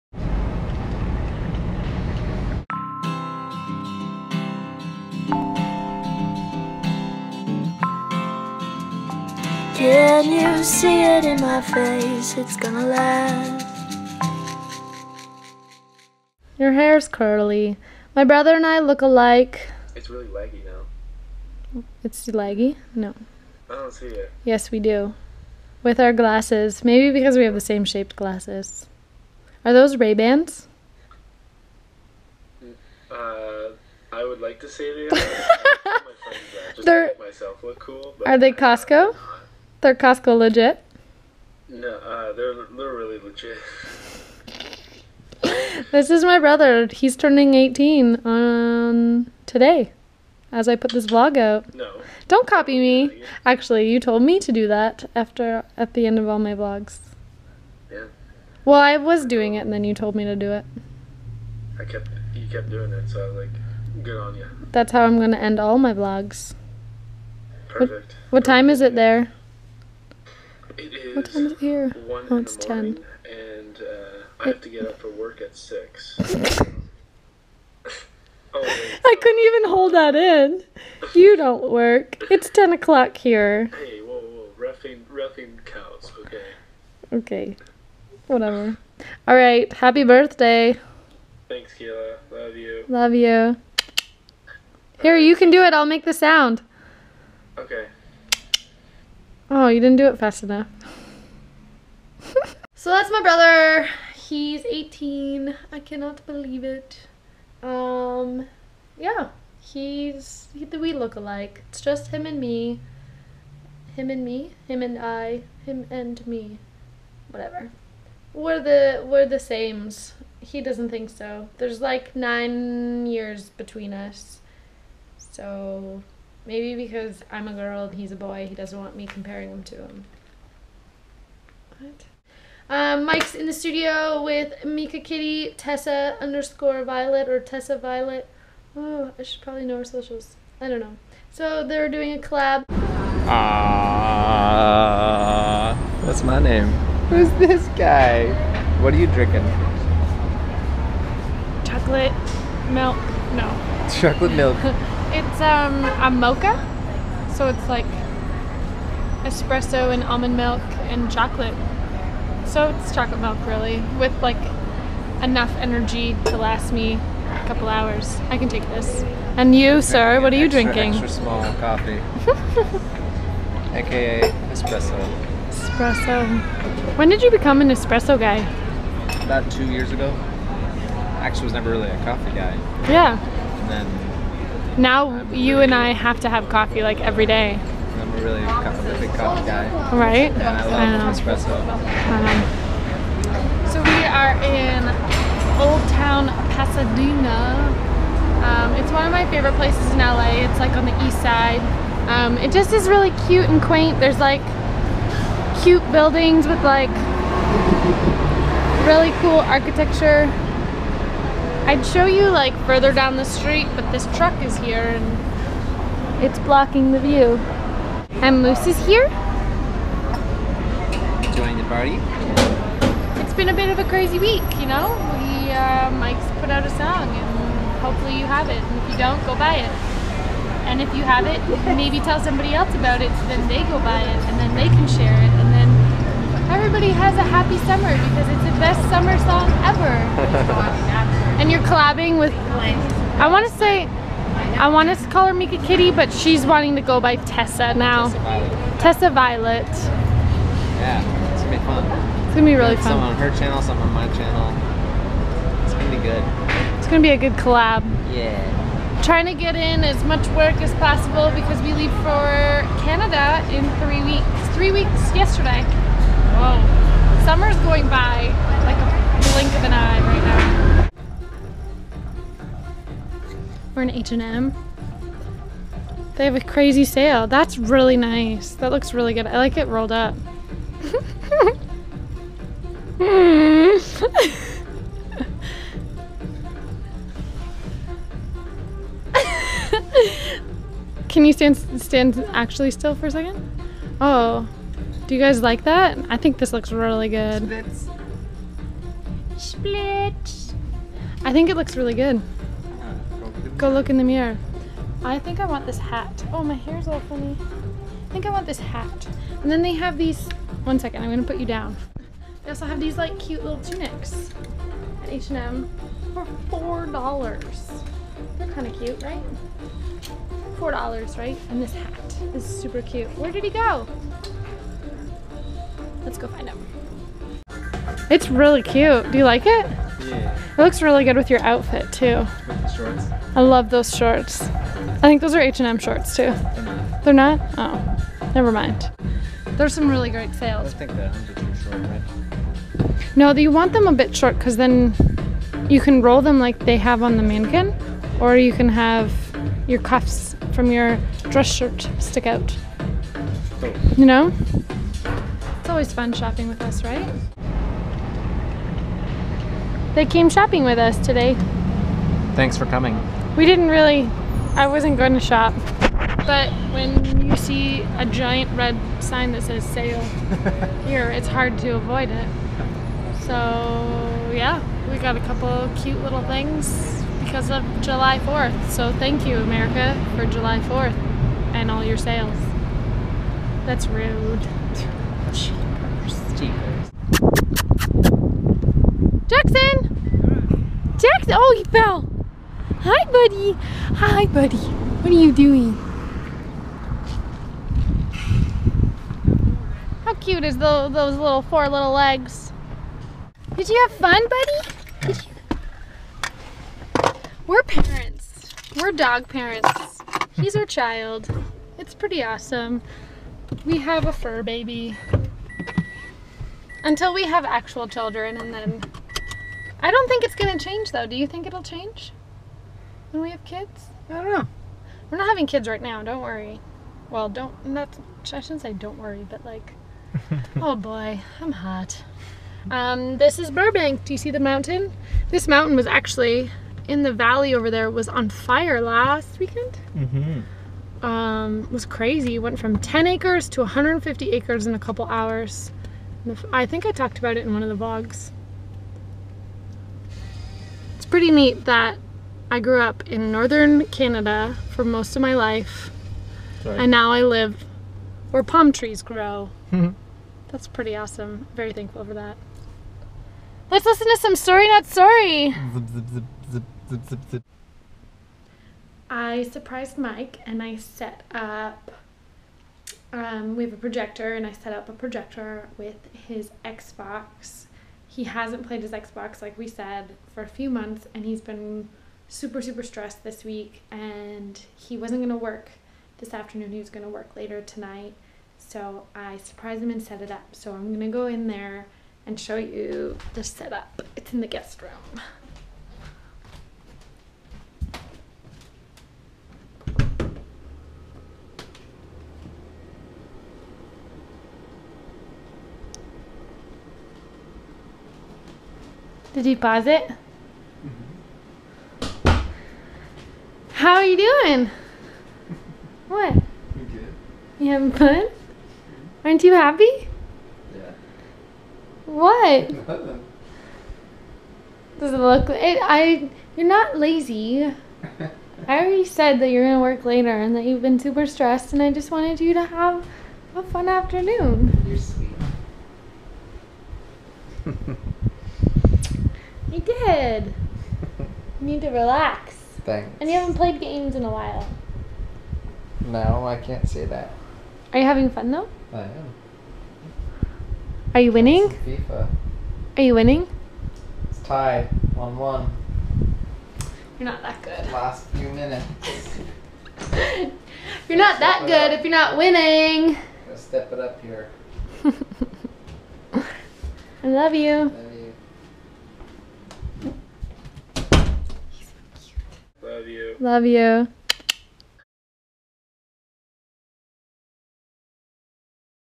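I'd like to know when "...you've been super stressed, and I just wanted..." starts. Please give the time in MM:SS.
08:50.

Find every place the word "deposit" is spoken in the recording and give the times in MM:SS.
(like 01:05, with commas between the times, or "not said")
08:29.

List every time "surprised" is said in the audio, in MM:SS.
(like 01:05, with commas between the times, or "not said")
07:49, 08:09.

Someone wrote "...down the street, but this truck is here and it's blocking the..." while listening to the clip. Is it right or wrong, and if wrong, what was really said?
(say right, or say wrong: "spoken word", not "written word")
right.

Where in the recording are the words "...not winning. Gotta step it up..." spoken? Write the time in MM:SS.
09:22.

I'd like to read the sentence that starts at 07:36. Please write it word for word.
and now I live where palm trees grow.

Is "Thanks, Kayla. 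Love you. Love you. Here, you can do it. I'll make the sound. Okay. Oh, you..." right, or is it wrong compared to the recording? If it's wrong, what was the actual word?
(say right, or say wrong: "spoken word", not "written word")
right.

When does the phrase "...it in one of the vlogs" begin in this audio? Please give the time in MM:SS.
07:27.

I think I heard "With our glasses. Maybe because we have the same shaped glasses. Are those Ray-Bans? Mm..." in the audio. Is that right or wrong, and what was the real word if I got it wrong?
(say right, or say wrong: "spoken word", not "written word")
right.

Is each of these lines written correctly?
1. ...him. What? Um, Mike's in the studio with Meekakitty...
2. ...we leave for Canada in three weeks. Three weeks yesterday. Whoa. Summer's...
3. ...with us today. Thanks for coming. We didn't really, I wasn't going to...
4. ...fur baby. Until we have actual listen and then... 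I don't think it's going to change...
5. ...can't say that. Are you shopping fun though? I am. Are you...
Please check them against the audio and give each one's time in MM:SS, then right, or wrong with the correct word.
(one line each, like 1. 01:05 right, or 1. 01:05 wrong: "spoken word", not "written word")
1. 02:09 right
2. 04:21 right
3. 06:00 right
4. 06:54 wrong: "children", not "listen"
5. 09:06 wrong: "having", not "shopping".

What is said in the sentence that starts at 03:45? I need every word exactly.
We, uh, Mike's put out a song and hopefully you have it.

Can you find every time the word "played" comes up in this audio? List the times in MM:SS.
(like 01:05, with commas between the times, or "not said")
07:58, 09:03.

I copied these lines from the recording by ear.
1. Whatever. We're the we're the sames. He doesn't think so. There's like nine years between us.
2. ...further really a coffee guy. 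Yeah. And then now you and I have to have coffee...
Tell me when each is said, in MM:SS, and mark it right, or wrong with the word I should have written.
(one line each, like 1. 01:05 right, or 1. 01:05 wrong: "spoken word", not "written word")
1. 01:57 right
2. 03:01 wrong: "never", not "further".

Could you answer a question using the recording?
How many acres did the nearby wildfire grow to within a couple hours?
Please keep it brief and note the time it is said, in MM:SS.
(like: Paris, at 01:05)
150, at 07:23.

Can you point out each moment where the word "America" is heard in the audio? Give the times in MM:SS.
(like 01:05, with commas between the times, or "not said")
06:19.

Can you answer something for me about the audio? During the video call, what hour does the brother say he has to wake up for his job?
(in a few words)
6.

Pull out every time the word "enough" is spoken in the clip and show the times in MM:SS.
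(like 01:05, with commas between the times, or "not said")
01:40, 02:45.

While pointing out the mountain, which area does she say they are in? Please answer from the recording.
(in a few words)
Burbank.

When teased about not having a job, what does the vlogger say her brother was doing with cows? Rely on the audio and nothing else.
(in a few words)
Roughing cows.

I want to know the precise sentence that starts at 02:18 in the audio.
Oh, I should probably know her socials.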